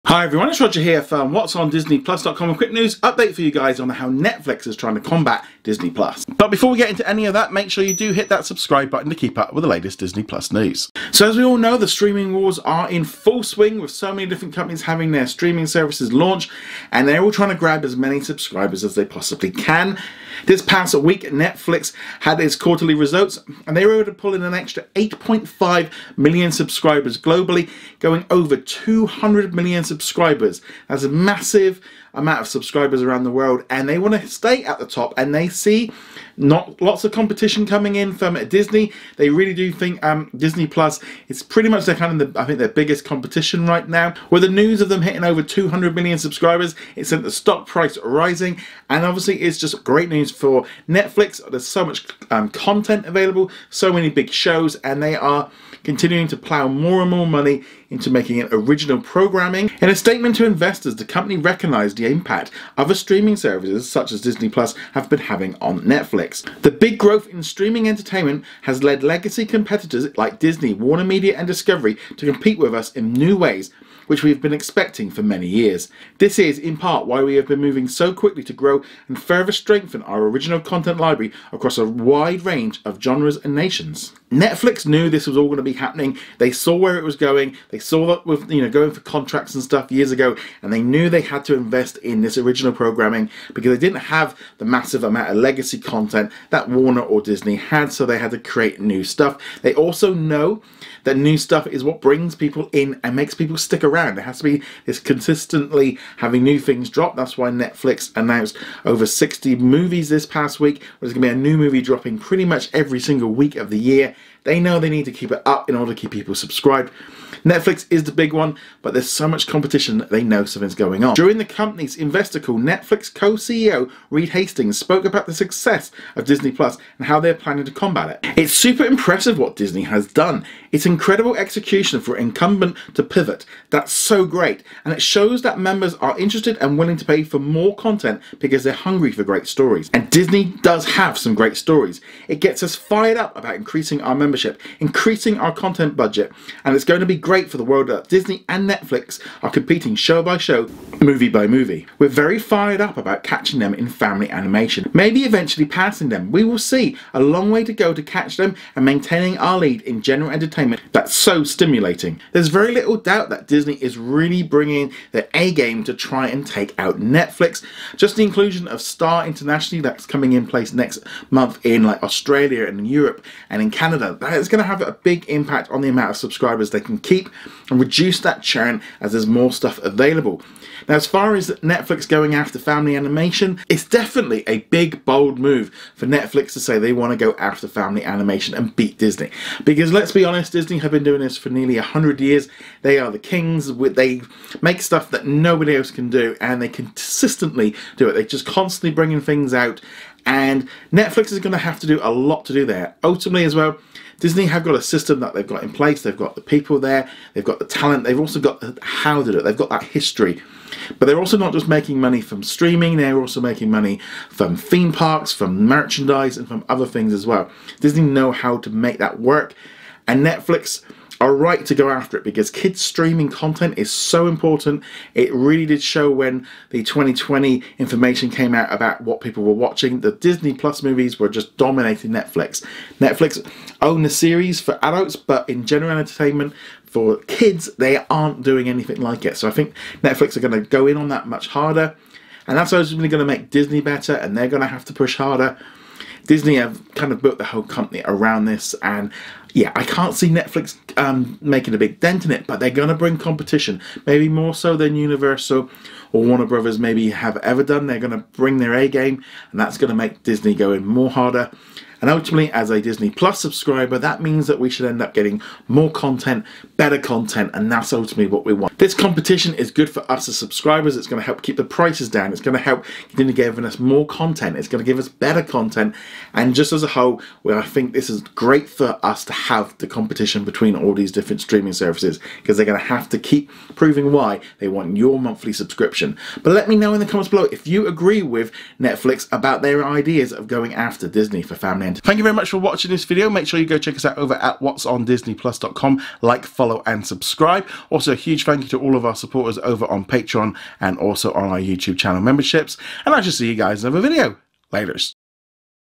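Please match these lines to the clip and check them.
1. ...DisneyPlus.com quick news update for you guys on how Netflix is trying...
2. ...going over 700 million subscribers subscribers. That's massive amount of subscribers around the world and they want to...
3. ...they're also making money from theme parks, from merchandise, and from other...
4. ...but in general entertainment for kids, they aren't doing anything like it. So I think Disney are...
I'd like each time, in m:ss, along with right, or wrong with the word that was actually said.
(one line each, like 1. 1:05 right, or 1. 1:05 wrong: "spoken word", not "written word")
1. 0:01 right
2. 0:27 wrong: "200", not "700"
3. 3:32 right
4. 3:55 wrong: "Netflix", not "Disney".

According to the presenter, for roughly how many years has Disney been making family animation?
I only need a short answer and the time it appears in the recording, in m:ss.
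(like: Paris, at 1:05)
nearly 100 years, at 3:11.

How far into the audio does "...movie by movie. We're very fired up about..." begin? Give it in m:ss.
2:31.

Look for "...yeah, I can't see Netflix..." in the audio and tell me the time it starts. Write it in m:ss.
4:09.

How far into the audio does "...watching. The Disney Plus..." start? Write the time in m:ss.
3:49.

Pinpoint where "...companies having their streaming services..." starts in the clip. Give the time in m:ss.
0:14.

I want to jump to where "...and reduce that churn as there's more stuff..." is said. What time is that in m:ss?
2:57.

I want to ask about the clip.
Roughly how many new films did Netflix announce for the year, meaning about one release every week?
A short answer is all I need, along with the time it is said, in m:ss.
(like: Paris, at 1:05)
over 60, at 1:48.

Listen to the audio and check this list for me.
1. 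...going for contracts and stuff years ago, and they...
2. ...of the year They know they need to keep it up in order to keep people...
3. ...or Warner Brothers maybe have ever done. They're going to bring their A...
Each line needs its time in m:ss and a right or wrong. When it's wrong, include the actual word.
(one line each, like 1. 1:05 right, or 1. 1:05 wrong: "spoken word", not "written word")
1. 1:28 right
2. 1:53 right
3. 4:16 right.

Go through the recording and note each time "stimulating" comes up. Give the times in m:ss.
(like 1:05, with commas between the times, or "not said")
2:41.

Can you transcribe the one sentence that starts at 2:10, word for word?
It's incredible execution for an incumbent to pivot.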